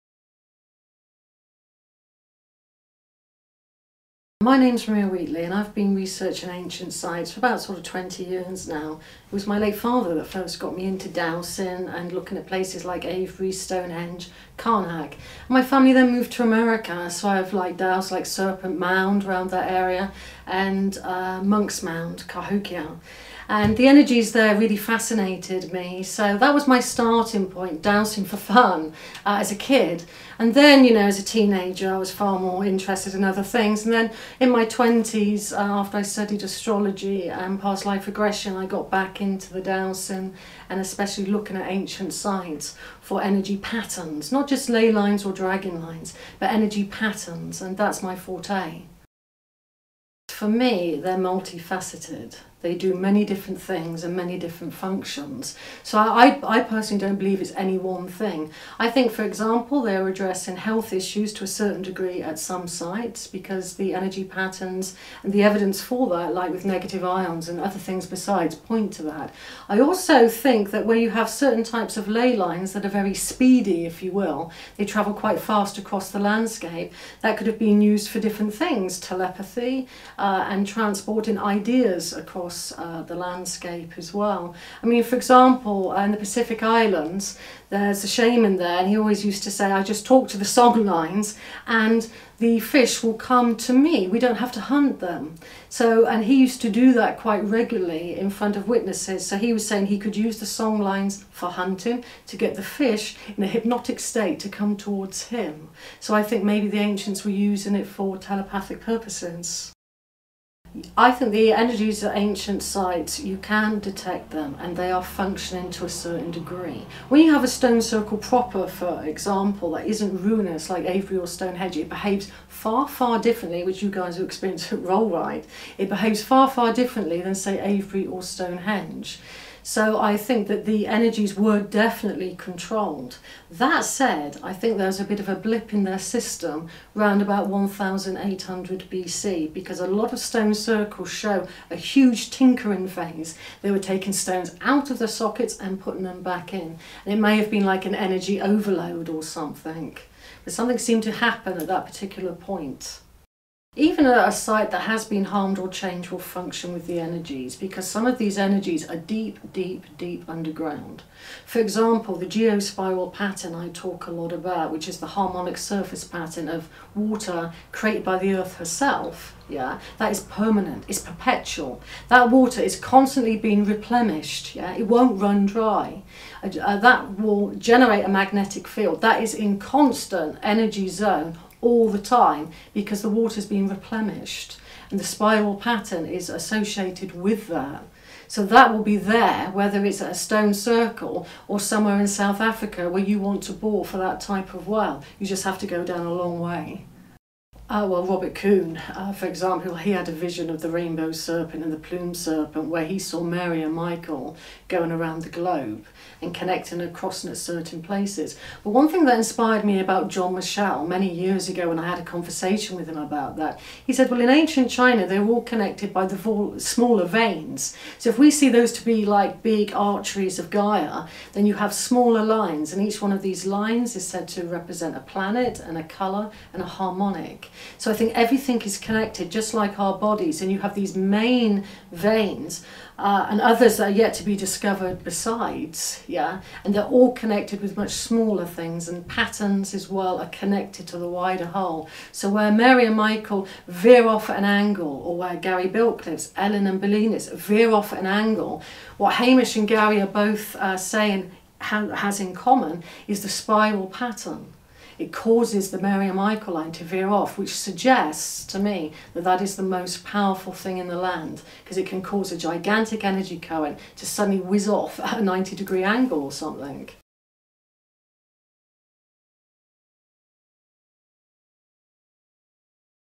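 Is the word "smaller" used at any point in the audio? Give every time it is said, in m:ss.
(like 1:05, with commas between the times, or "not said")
3:36, 3:41, 3:57.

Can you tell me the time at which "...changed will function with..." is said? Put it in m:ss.
2:35.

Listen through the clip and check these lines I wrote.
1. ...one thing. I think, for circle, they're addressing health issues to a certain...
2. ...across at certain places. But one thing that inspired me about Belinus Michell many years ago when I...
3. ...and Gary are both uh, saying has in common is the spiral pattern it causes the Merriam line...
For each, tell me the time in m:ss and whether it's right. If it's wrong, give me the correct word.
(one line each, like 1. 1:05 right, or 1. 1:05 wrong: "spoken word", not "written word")
1. 0:57 wrong: "example", not "circle"
2. 3:26 wrong: "John", not "Belinus"
3. 4:09 right.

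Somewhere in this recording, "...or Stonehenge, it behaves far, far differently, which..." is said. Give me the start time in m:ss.
2:01.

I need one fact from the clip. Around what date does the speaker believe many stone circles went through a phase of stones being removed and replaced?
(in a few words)
1800 BC.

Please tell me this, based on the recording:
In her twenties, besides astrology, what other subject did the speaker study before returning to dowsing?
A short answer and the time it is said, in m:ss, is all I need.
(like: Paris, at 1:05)
past life regression, at 0:37.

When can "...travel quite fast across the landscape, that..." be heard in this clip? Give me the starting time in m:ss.
1:14.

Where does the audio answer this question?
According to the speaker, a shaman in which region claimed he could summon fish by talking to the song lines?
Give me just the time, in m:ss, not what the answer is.
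1:26.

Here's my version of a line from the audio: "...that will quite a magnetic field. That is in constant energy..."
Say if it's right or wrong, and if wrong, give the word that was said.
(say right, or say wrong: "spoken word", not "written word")
wrong: "generate", not "quite".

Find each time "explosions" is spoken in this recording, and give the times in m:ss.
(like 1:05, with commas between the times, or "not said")
not said.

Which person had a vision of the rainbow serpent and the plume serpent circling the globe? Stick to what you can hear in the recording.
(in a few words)
Robert Coon.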